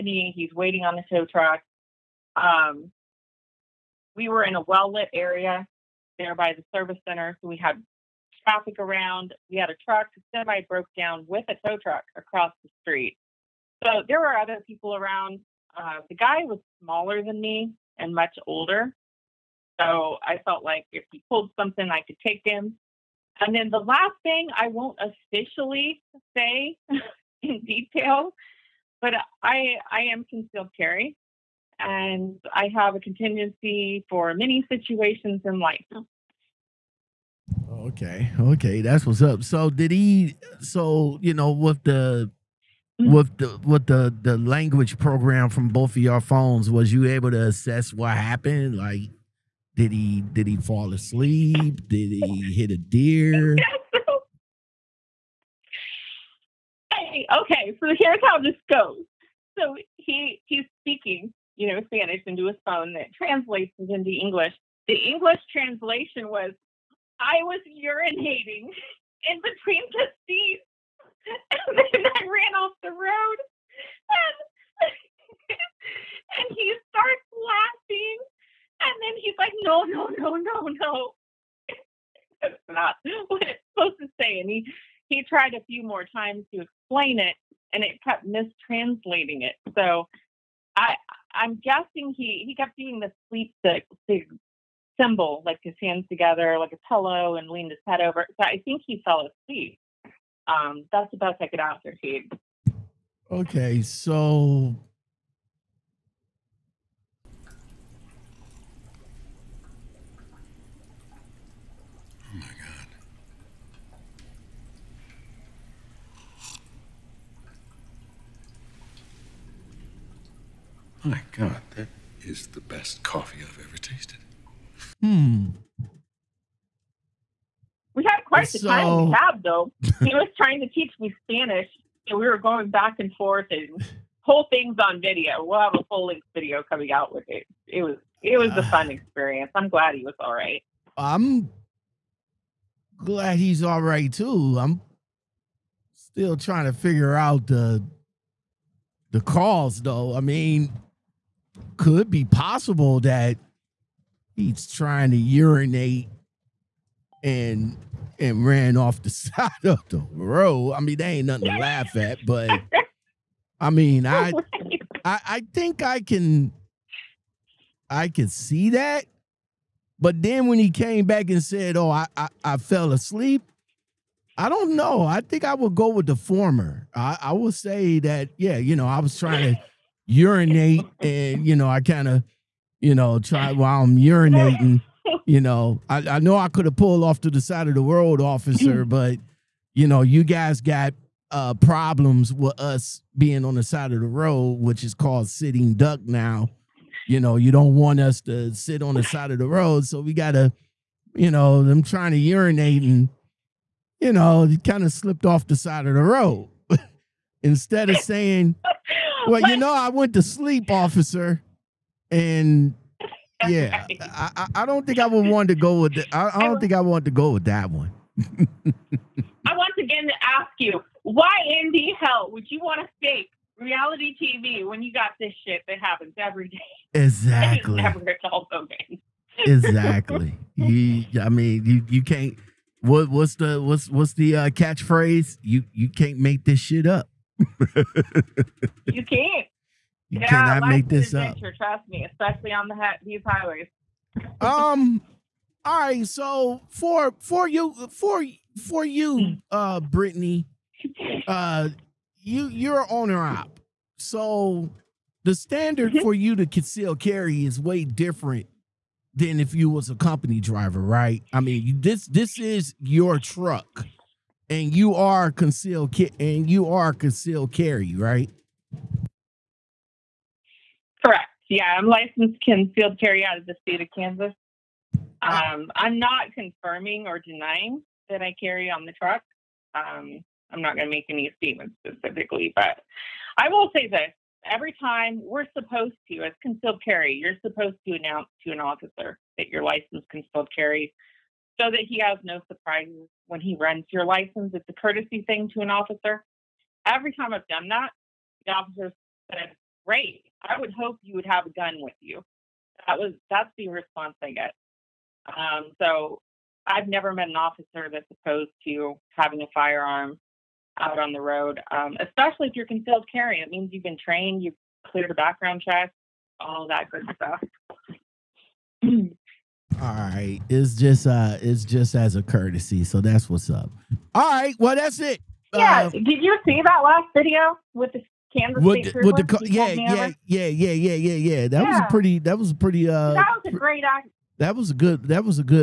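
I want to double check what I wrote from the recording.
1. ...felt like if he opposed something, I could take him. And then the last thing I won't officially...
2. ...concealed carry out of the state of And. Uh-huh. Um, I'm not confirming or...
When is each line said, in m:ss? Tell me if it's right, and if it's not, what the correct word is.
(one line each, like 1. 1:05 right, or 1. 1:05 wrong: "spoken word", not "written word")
1. 0:20 wrong: "pulled", not "opposed"
2. 4:32 wrong: "Kansas", not "And".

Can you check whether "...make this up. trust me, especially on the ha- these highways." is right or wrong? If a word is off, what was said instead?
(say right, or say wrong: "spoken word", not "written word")
right.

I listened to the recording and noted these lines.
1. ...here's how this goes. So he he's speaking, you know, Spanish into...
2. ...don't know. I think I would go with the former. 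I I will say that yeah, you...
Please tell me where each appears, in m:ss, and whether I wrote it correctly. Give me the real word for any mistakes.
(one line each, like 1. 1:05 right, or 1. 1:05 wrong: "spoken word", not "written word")
1. 0:57 right
2. 2:54 right.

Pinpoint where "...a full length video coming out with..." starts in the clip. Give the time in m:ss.
2:15.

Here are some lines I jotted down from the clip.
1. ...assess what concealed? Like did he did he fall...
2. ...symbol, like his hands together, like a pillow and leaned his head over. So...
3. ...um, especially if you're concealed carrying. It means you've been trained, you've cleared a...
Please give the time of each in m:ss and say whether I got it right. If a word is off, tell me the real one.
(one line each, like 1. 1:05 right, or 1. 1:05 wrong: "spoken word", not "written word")
1. 0:47 wrong: "happened", not "concealed"
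2. 1:35 right
3. 5:11 right.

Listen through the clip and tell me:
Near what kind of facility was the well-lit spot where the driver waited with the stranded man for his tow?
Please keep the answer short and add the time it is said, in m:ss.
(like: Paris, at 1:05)
service center, at 0:06.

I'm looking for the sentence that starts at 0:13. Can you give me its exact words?
So there were other people around.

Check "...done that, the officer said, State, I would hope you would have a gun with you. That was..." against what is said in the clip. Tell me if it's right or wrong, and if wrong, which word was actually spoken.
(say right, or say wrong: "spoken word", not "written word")
wrong: "Great", not "State".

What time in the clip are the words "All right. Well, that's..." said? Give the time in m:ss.
5:24.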